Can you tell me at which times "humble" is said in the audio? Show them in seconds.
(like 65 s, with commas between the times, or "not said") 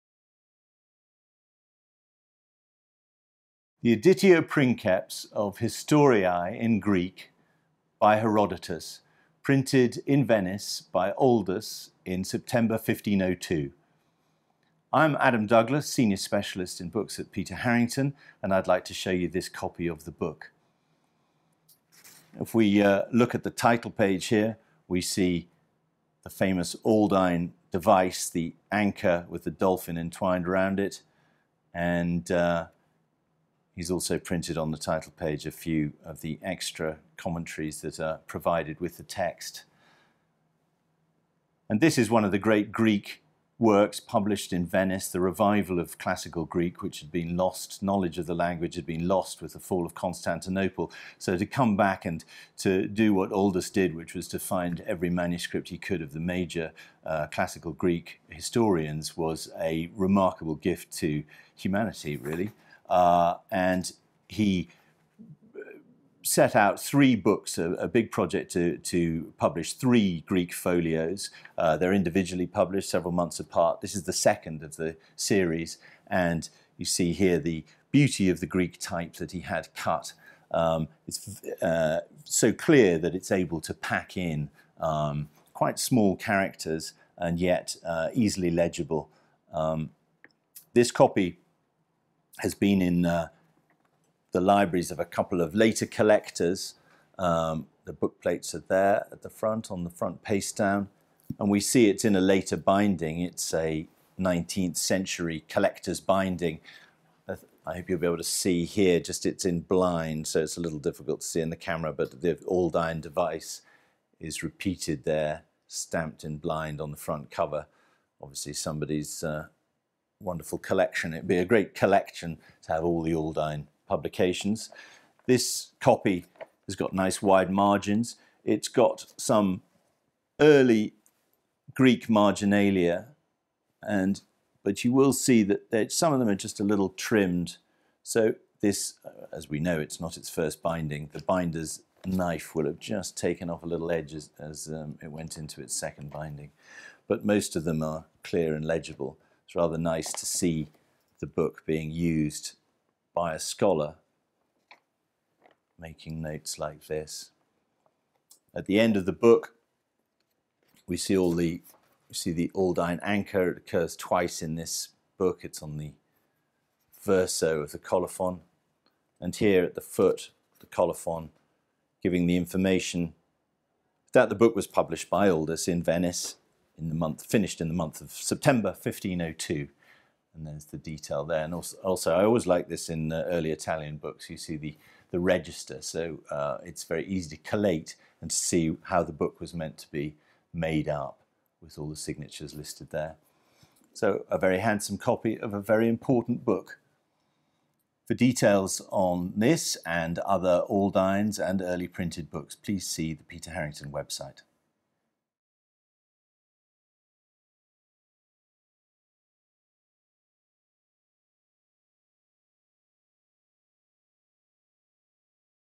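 not said.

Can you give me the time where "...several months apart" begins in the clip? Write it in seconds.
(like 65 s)
72 s.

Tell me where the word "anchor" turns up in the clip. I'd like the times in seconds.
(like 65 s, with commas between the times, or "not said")
28 s, 163 s.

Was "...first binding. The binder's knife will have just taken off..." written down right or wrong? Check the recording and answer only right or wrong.
right.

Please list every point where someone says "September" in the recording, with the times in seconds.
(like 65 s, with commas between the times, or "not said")
12 s, 178 s.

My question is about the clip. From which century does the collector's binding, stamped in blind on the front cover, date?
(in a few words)
19th century.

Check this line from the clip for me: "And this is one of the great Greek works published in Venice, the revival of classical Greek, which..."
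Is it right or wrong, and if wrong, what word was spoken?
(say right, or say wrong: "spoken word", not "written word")
right.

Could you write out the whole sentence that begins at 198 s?
For details on this and other Aldines and early printed books, please see the Peter Harrington website.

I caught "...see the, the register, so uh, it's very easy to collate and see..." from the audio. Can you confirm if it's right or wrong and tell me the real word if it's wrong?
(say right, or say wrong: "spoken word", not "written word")
right.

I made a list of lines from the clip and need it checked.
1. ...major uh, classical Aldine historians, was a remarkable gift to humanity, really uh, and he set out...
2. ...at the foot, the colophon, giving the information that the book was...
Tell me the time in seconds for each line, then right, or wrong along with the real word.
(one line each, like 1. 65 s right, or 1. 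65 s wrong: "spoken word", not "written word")
1. 56 s wrong: "Greek", not "Aldine"
2. 169 s right.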